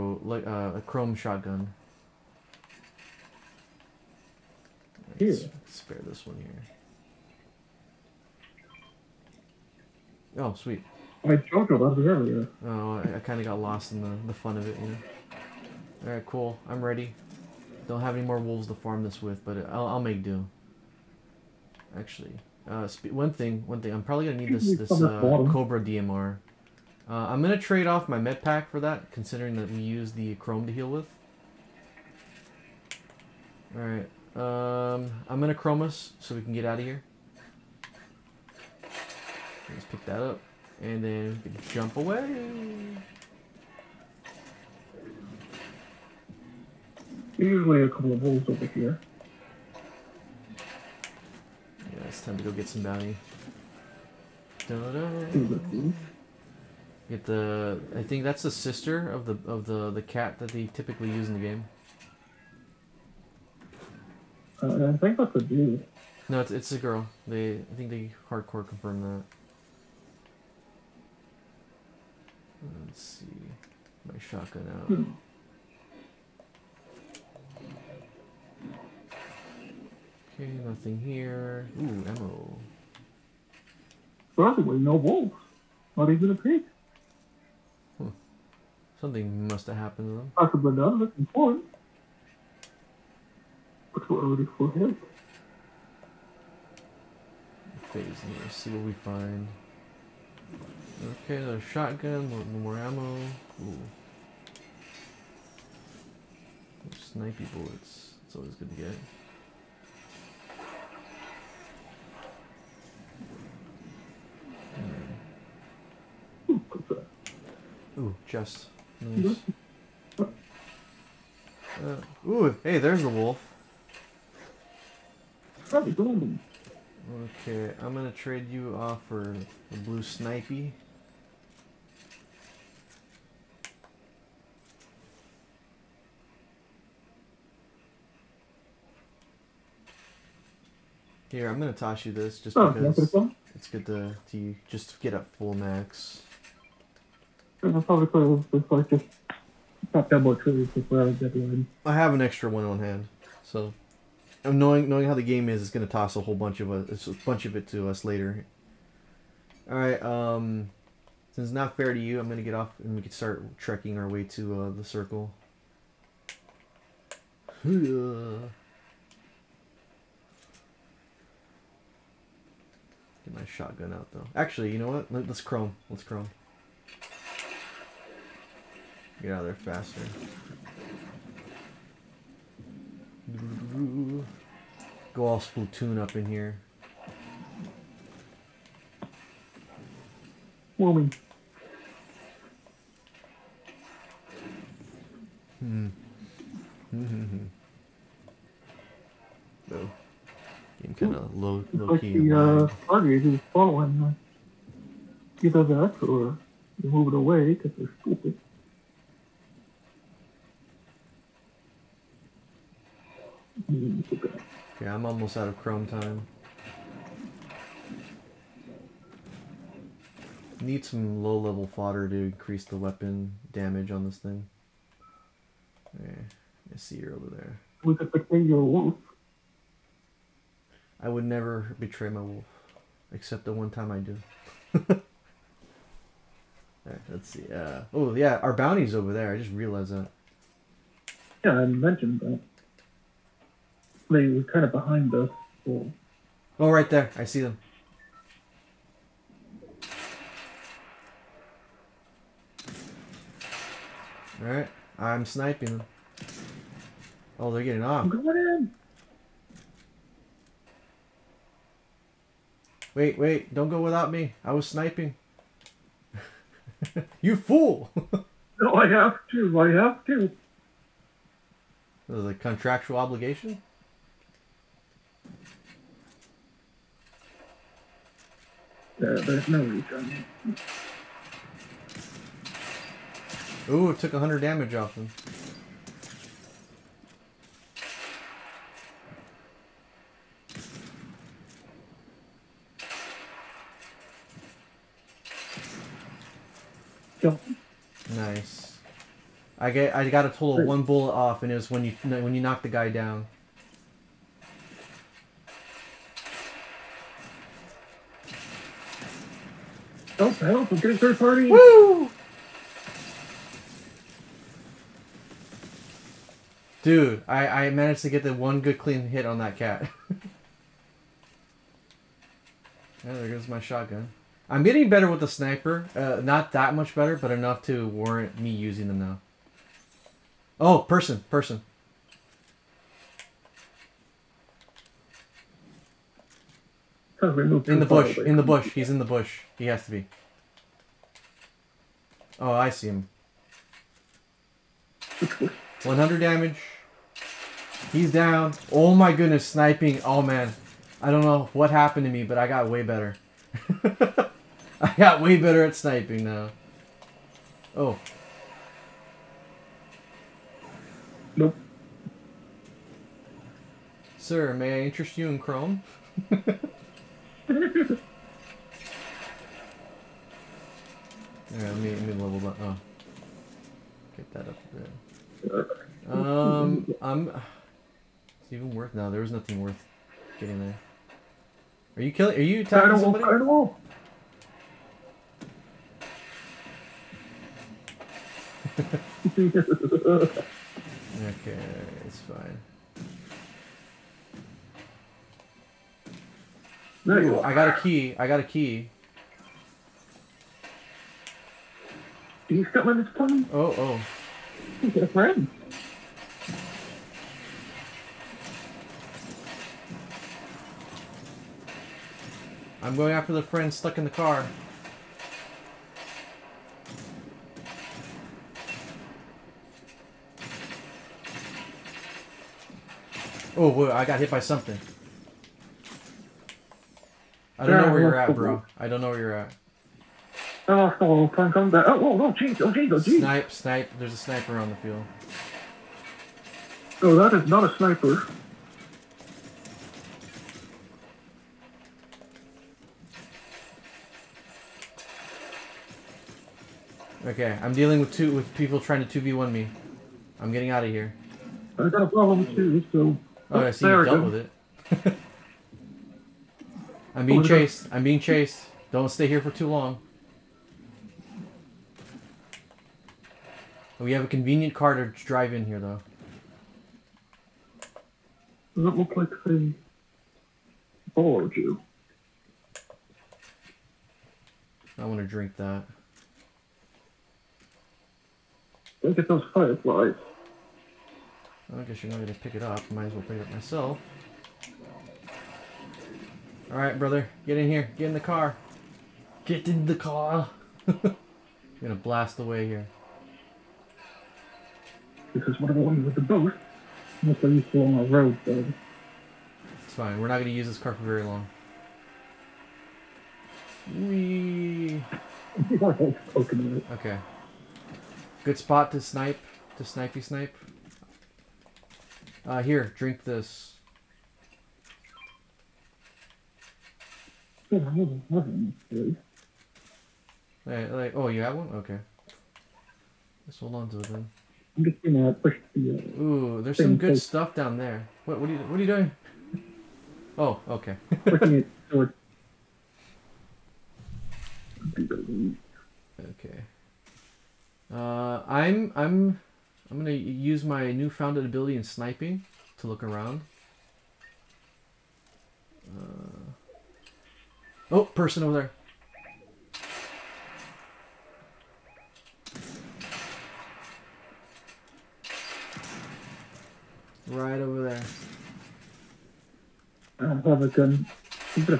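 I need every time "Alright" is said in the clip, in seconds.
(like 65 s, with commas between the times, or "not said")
16 s, 33 s, 254 s, 367 s.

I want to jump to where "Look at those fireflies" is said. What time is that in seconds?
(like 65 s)
479 s.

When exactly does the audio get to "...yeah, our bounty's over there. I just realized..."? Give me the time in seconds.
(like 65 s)
238 s.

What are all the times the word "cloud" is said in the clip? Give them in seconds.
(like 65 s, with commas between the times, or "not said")
not said.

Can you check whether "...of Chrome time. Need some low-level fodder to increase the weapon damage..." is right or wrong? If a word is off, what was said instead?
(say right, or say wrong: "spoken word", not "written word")
right.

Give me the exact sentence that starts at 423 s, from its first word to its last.
Oh, whoa, I got hit by something.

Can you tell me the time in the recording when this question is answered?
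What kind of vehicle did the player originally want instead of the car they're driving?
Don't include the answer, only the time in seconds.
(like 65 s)
496 s.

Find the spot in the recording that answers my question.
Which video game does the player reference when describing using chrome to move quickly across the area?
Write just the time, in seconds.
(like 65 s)
185 s.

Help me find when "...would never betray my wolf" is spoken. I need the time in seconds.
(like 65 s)
231 s.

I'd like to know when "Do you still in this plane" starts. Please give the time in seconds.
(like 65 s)
402 s.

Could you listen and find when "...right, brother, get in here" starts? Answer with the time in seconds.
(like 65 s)
486 s.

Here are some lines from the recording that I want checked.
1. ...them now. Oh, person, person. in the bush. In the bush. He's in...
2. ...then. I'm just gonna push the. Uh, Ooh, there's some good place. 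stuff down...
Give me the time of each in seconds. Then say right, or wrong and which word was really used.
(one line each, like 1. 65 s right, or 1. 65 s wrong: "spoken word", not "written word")
1. 328 s right
2. 524 s right.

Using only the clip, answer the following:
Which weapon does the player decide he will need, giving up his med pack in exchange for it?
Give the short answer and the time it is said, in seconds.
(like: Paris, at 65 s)
Cobra DMR, at 25 s.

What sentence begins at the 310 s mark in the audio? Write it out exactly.
Help, oh, help, I'm getting third party.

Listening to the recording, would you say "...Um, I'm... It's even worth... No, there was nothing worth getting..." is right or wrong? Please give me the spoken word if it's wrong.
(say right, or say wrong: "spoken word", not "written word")
right.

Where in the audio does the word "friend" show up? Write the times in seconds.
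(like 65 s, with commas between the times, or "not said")
405 s, 413 s.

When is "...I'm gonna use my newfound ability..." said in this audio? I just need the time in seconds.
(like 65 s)
539 s.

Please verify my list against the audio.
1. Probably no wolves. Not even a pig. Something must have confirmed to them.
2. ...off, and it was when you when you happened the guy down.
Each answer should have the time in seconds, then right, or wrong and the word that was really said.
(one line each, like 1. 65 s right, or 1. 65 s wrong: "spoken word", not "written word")
1. 84 s wrong: "happened", not "confirmed"
2. 301 s wrong: "knocked", not "happened".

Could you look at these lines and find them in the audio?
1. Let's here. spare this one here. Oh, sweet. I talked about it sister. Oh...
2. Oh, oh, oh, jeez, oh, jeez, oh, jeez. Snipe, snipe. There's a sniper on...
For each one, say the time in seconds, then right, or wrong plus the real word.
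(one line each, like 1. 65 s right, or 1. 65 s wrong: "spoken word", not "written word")
1. 5 s wrong: "earlier", not "sister"
2. 431 s right.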